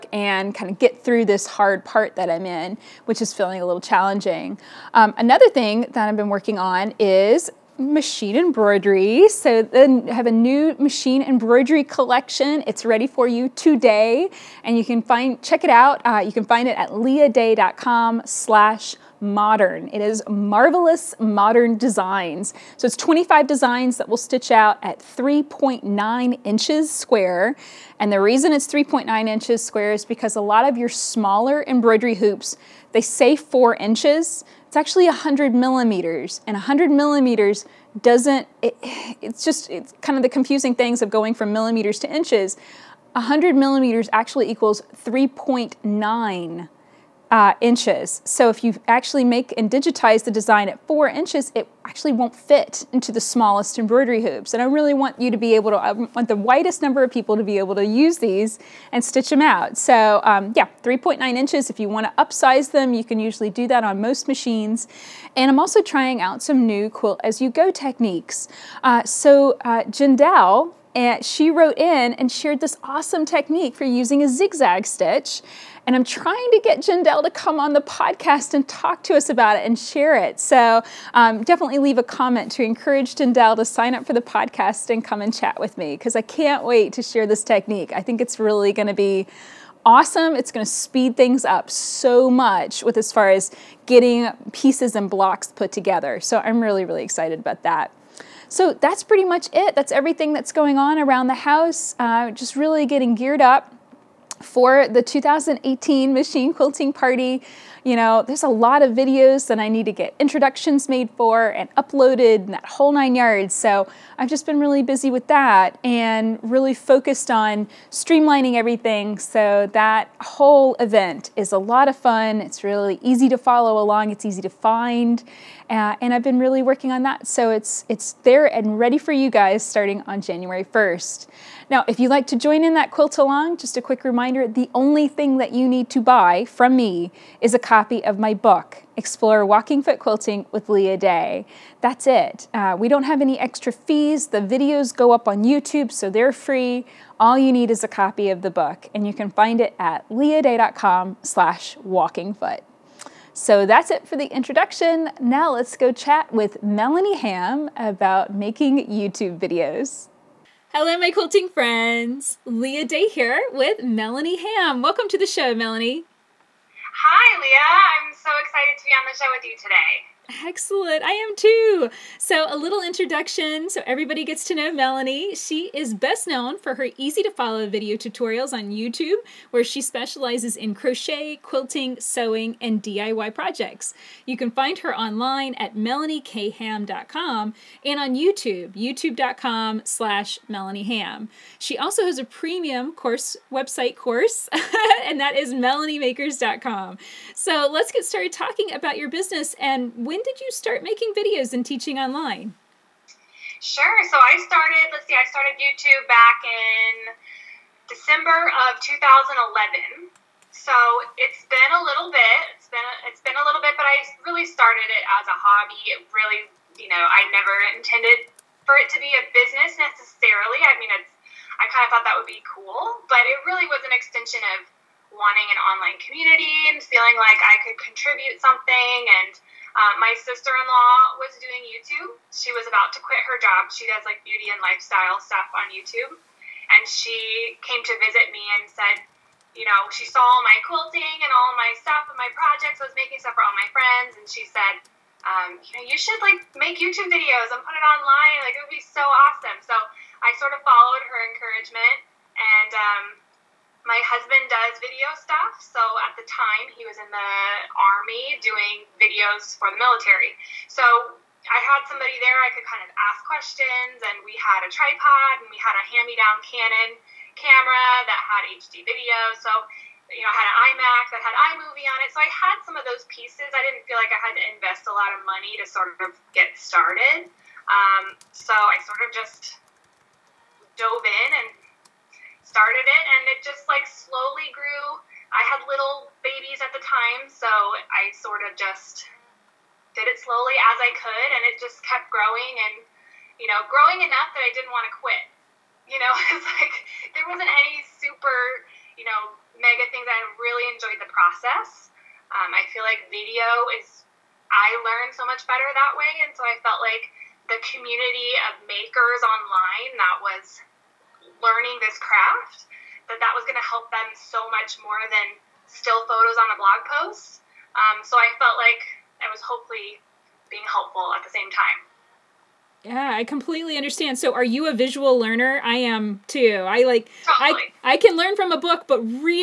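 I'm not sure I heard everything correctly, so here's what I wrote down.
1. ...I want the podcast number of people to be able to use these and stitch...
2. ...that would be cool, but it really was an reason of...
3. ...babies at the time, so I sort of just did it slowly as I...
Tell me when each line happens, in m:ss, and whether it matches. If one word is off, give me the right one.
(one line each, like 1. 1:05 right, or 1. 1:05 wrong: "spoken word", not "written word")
1. 0:55 wrong: "widest", not "podcast"
2. 3:42 wrong: "extension", not "reason"
3. 4:46 right.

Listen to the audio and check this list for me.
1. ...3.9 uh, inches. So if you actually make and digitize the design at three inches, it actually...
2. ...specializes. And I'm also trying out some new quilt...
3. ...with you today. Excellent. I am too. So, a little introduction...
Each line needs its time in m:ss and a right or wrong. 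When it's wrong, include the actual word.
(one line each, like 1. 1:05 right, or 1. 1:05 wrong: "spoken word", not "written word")
1. 0:45 wrong: "four", not "three"
2. 1:04 wrong: "machines", not "specializes"
3. 2:49 right.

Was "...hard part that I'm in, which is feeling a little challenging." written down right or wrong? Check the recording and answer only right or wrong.
right.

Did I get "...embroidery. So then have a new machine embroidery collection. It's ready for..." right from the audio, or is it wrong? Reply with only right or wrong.
right.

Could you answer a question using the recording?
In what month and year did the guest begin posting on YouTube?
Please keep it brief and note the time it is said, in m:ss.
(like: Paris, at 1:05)
December 2011, at 3:27.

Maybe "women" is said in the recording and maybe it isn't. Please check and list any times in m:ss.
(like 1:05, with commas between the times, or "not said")
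not said.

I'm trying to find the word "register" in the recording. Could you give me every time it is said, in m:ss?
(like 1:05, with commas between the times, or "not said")
not said.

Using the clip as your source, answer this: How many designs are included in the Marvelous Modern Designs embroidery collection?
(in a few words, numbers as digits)
25.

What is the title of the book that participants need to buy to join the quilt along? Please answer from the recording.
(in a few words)
Explore Walking Foot Quilting.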